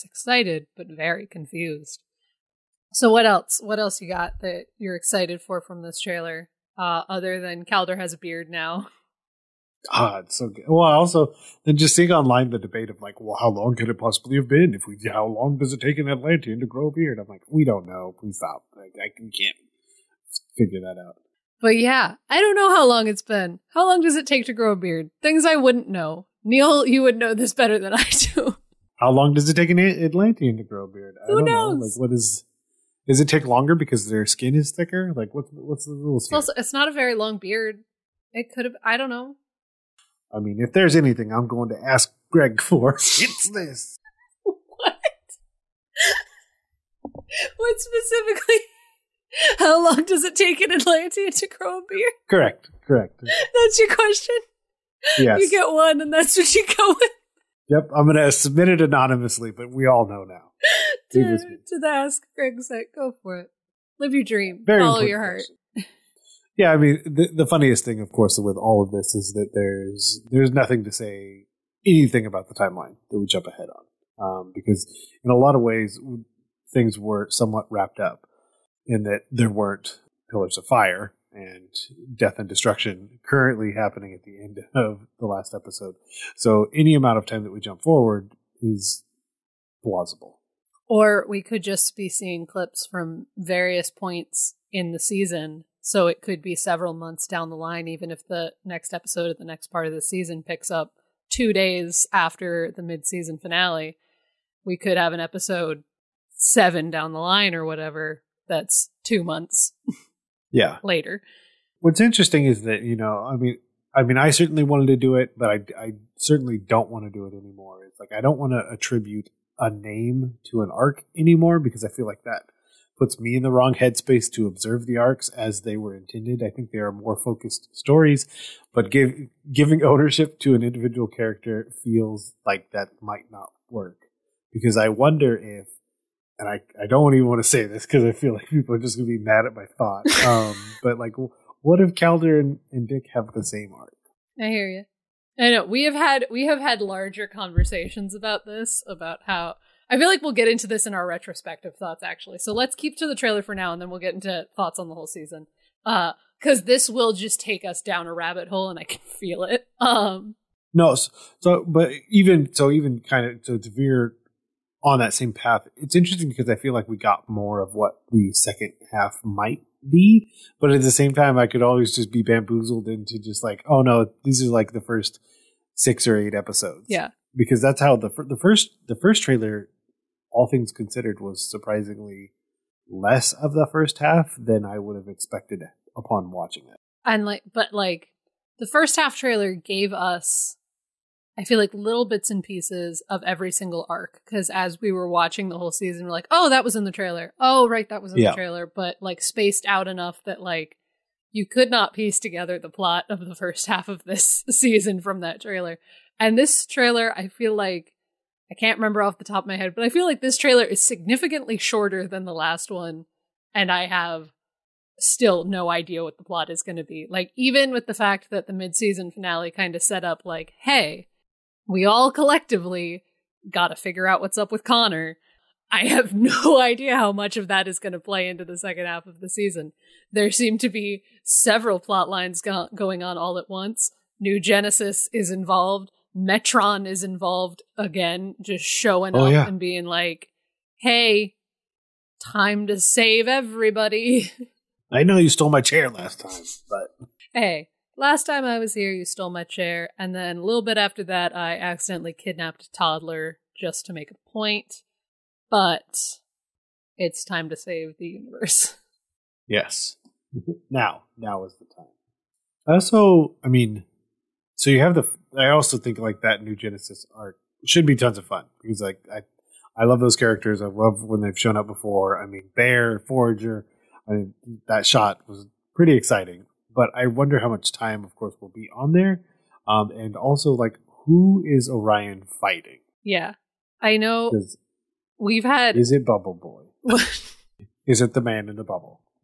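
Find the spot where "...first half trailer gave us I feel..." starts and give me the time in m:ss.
3:08.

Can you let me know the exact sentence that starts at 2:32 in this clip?
So let's keep to the trailer for now, and then we'll get into thoughts on the whole season.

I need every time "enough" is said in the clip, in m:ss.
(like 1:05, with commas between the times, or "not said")
3:19.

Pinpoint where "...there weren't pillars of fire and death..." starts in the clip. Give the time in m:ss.
1:19.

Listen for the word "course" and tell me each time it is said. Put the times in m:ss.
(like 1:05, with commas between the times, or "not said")
1:08, 4:38.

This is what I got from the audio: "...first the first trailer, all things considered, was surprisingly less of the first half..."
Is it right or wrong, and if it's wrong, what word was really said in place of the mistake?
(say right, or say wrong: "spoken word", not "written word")
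right.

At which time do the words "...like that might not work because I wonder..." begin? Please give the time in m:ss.
2:12.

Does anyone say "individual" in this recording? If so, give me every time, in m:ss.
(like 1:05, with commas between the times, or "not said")
2:10.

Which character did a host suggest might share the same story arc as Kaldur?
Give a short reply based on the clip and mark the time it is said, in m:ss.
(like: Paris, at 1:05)
Dick, at 2:22.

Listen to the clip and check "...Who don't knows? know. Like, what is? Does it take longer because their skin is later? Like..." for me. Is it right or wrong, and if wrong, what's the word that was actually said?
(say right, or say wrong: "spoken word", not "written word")
wrong: "thicker", not "later".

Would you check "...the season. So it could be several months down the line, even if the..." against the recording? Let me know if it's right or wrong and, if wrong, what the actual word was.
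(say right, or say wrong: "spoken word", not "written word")
right.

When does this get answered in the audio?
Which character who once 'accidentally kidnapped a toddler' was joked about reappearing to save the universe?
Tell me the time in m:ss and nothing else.
3:56.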